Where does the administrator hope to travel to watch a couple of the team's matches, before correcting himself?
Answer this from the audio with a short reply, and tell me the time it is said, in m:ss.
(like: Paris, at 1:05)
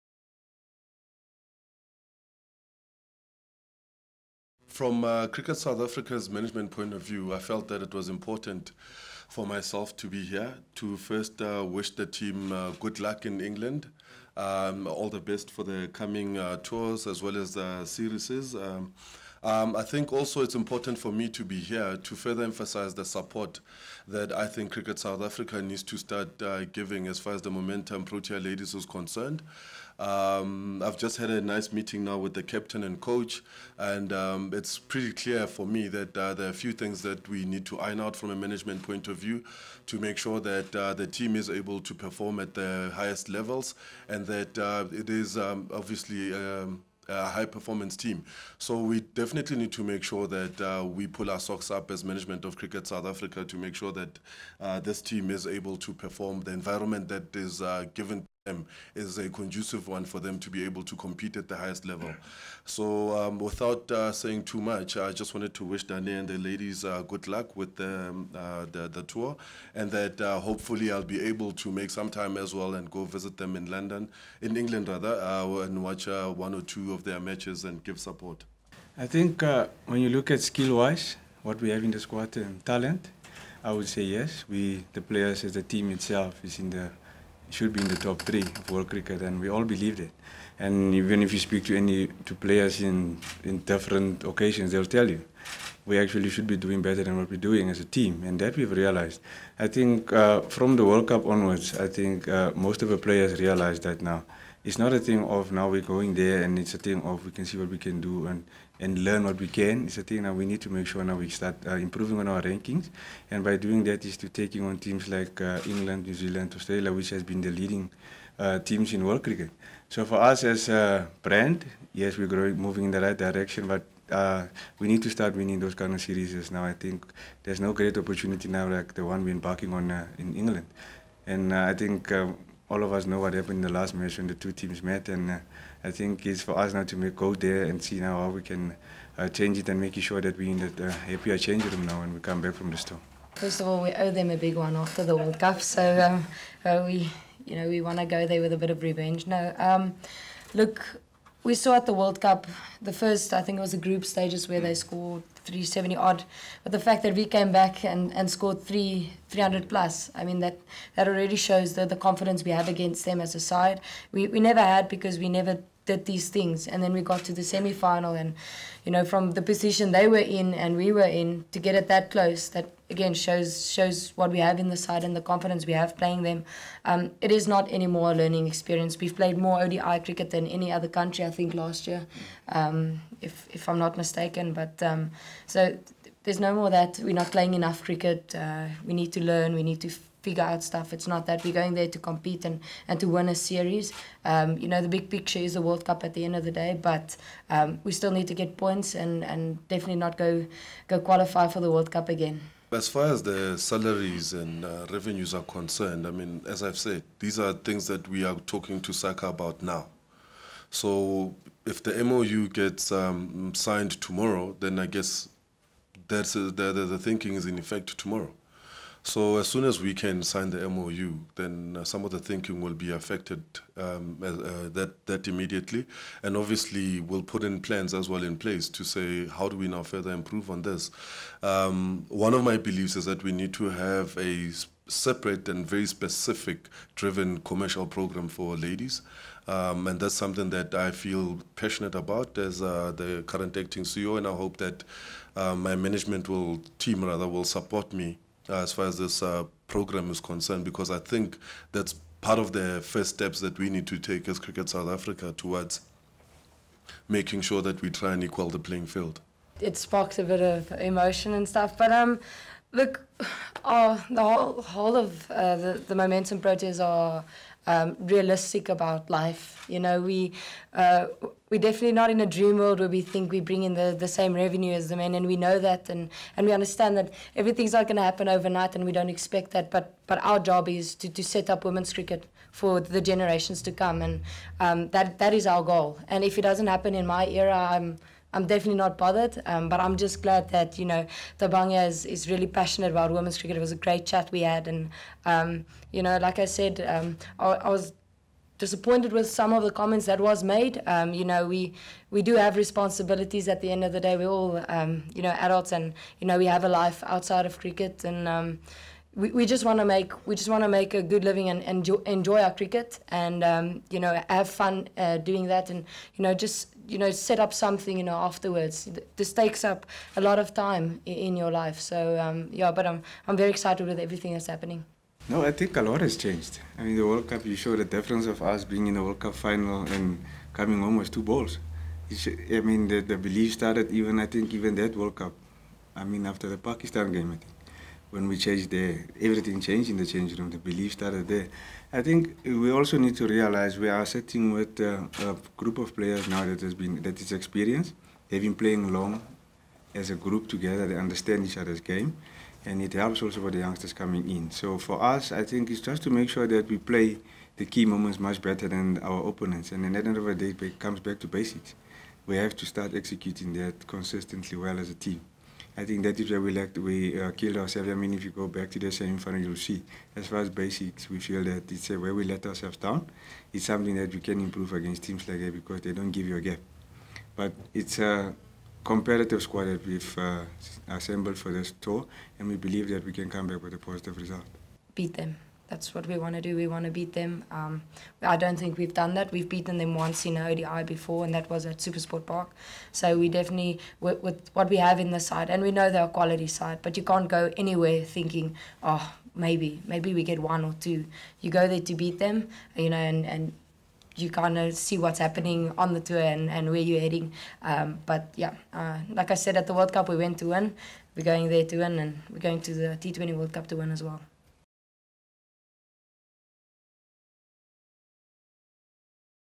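London, at 1:13.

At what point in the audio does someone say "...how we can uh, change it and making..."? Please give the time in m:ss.
2:18.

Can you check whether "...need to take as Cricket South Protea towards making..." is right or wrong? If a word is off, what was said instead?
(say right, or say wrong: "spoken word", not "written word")
wrong: "Africa", not "Protea".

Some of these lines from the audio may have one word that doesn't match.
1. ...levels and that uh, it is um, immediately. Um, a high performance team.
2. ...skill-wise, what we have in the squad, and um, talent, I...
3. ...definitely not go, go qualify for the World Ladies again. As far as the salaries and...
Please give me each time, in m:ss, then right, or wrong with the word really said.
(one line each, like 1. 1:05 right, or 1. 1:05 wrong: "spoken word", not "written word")
1. 0:43 wrong: "obviously", not "immediately"
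2. 1:20 right
3. 3:19 wrong: "Cup", not "Ladies".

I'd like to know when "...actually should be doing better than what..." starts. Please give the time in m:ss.
1:35.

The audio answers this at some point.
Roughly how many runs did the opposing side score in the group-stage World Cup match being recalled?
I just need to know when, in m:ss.
2:35.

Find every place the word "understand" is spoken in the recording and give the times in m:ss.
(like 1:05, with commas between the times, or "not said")
4:36, 5:50.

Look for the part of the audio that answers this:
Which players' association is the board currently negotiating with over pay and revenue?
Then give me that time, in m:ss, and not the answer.
3:28.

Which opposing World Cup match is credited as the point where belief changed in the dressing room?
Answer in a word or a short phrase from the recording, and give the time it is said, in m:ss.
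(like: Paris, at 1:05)
Pakistan, at 5:36.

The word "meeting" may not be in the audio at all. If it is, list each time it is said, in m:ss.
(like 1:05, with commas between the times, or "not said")
0:31.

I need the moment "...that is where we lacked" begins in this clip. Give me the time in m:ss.
6:06.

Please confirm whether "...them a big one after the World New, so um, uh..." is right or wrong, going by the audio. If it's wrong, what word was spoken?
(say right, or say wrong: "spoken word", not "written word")
wrong: "Cup", not "New".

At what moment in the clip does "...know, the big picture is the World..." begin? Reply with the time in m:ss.
3:14.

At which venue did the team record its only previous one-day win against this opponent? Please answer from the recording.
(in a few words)
Supersport Park.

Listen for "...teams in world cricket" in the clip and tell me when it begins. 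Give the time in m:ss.
1:58.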